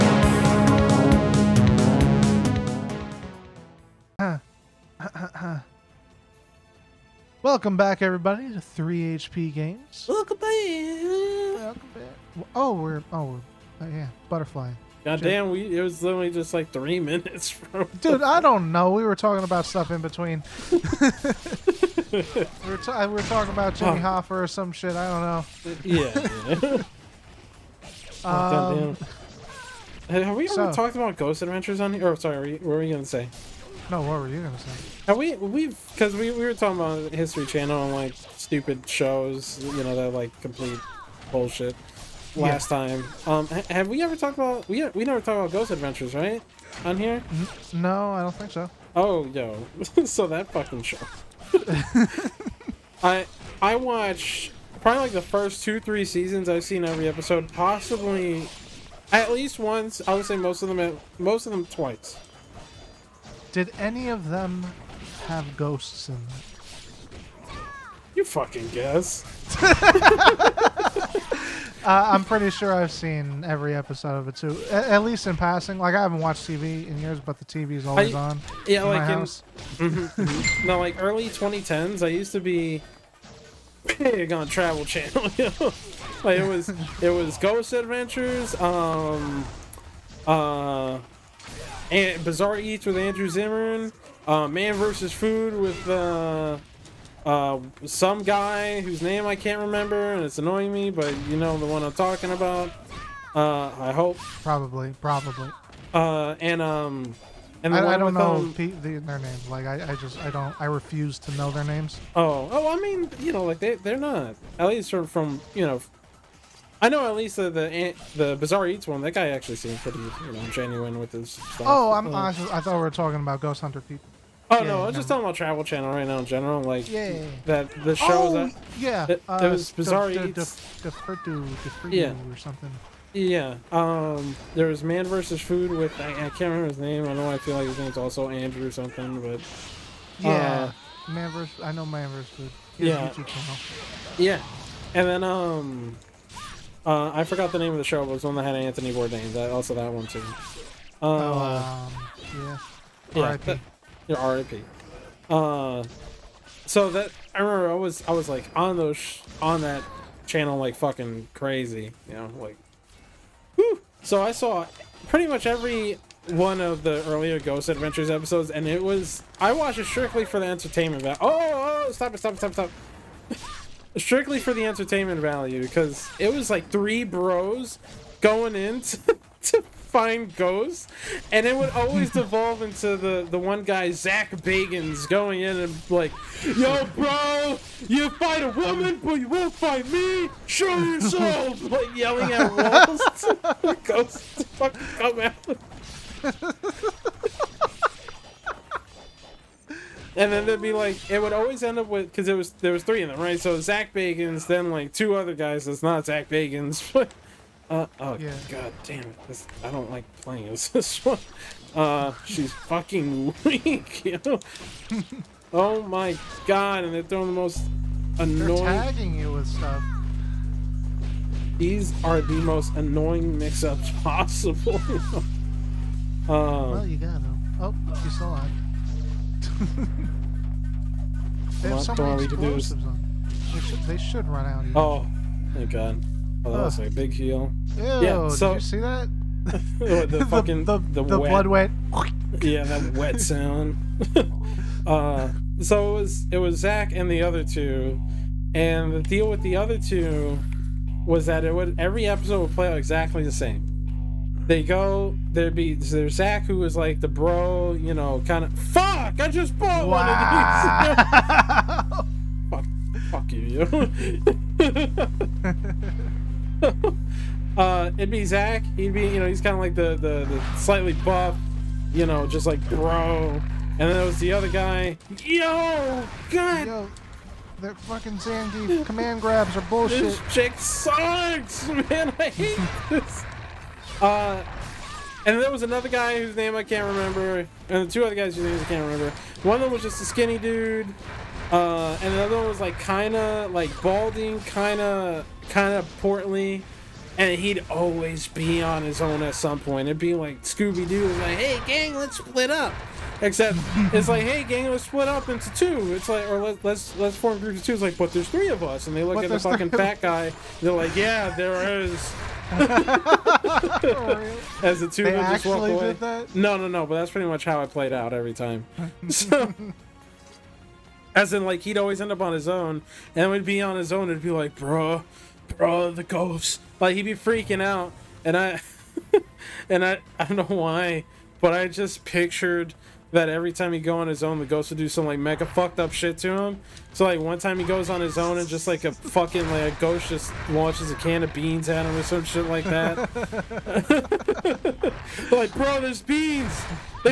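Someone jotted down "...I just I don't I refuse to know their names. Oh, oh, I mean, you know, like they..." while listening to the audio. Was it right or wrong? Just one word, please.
right.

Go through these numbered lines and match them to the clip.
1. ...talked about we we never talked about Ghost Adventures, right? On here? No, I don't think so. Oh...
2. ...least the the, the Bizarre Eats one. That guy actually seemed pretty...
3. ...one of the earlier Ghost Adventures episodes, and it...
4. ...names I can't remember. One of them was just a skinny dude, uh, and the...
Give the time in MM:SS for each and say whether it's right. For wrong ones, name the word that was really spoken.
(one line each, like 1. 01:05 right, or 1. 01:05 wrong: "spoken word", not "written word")
1. 00:44 right
2. 01:57 right
3. 02:46 right
4. 04:48 right.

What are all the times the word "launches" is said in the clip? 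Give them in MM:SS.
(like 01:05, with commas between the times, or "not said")
05:40.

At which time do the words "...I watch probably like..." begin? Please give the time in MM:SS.
00:53.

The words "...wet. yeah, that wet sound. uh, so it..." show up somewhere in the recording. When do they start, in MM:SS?
04:01.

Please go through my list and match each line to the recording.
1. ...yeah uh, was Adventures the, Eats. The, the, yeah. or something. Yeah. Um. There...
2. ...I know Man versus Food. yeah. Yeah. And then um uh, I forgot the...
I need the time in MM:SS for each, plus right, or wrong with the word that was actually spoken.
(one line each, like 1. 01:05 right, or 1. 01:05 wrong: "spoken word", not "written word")
1. 02:08 wrong: "Bizarre", not "Adventures"
2. 02:21 right.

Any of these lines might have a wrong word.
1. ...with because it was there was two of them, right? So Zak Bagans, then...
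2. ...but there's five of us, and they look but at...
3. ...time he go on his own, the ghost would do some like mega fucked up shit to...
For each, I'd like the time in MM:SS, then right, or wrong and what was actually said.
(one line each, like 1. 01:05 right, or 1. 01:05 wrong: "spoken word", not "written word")
1. 03:21 wrong: "three", not "two"
2. 05:07 wrong: "three", not "five"
3. 05:33 right.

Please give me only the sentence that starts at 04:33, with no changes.
And then there was the other guy.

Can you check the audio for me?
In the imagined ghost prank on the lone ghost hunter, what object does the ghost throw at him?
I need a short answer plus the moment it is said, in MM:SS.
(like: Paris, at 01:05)
A can of beans, at 05:40.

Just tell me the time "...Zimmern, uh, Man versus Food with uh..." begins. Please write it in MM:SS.
01:33.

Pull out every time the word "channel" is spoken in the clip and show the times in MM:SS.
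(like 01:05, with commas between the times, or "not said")
00:37, 01:24, 02:05, 02:40.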